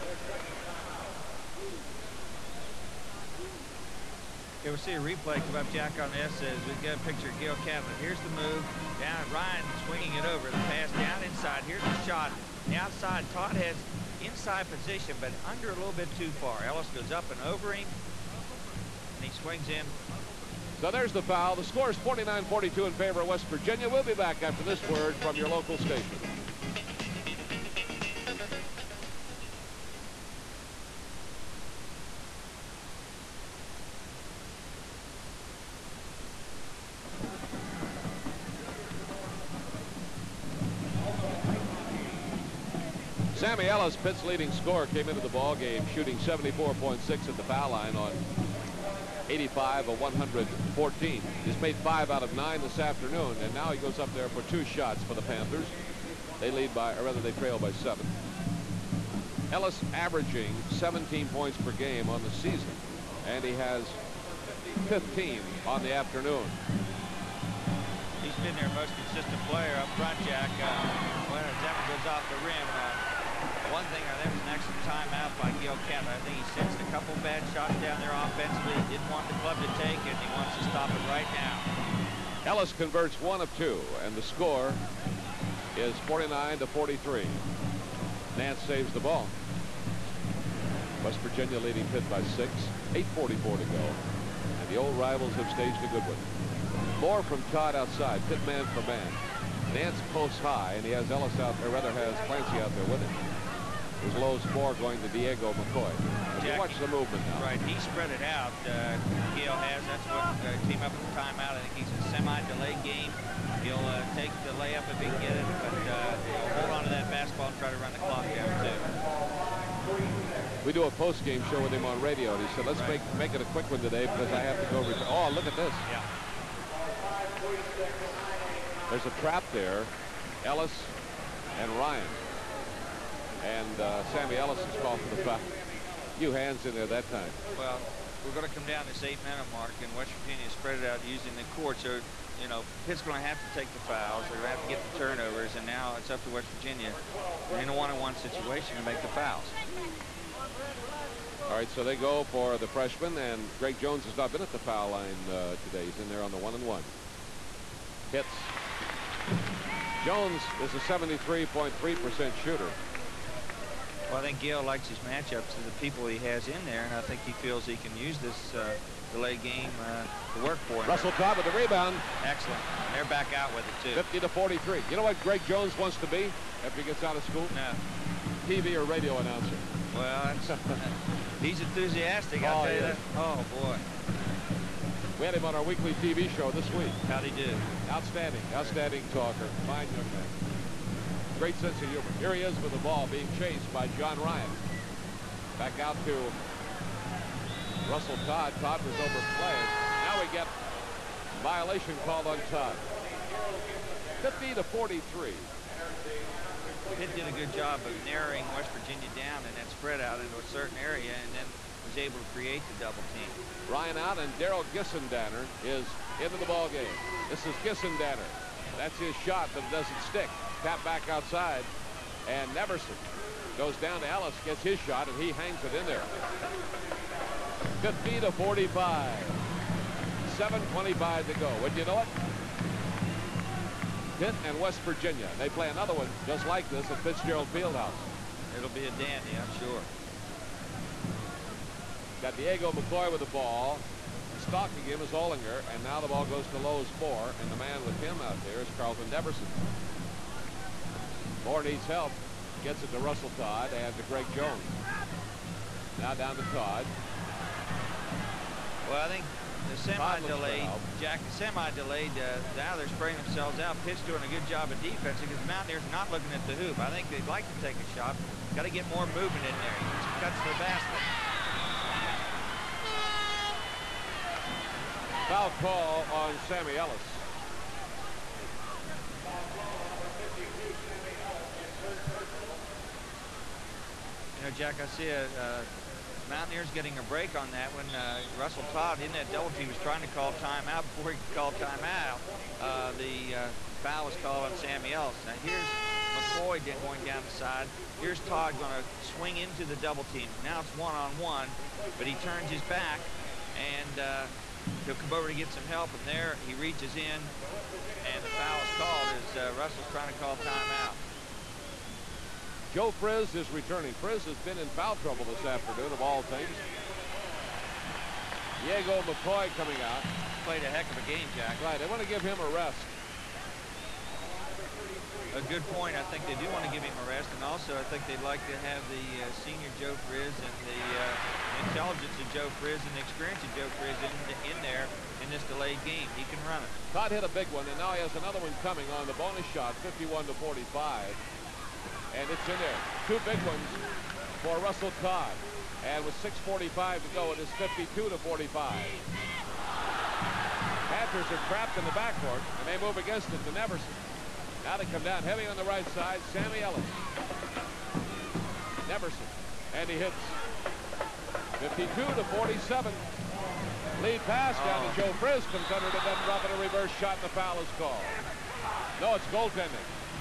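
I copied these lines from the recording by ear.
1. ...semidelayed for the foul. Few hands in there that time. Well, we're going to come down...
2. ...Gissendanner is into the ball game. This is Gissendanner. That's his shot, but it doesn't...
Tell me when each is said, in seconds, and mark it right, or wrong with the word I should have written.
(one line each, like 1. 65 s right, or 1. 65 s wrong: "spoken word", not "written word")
1. 134 s wrong: "called", not "semidelayed"
2. 214 s right.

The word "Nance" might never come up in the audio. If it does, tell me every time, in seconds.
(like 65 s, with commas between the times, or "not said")
88 s, 99 s.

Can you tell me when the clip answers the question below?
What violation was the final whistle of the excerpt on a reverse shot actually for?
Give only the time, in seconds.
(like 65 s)
369 s.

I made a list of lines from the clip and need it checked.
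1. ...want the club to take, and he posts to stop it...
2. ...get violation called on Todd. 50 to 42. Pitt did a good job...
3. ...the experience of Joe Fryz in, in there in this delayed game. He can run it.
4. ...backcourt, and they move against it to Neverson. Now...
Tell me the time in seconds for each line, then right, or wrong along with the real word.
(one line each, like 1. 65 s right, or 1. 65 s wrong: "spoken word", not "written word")
1. 79 s wrong: "wants", not "posts"
2. 200 s wrong: "43", not "42"
3. 332 s right
4. 351 s right.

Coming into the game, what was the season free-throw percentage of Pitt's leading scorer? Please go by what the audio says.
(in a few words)
74.6.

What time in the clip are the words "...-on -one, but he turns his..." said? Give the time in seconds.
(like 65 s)
301 s.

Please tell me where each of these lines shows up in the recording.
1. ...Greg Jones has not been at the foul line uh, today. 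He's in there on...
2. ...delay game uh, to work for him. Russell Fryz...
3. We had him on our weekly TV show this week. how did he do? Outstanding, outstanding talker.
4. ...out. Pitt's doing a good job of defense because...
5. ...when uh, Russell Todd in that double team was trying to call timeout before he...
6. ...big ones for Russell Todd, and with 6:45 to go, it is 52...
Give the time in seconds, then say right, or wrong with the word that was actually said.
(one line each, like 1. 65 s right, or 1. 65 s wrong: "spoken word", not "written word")
1. 153 s right
2. 169 s wrong: "Cobb", not "Fryz"
3. 185 s right
4. 263 s right
5. 287 s right
6. 343 s right.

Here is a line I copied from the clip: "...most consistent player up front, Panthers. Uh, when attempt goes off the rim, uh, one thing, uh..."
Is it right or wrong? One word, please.
wrong.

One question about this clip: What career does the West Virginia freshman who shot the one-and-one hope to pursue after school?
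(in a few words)
TV or radio announcer.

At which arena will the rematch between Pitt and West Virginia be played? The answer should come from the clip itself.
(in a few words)
Fitzgerald Fieldhouse.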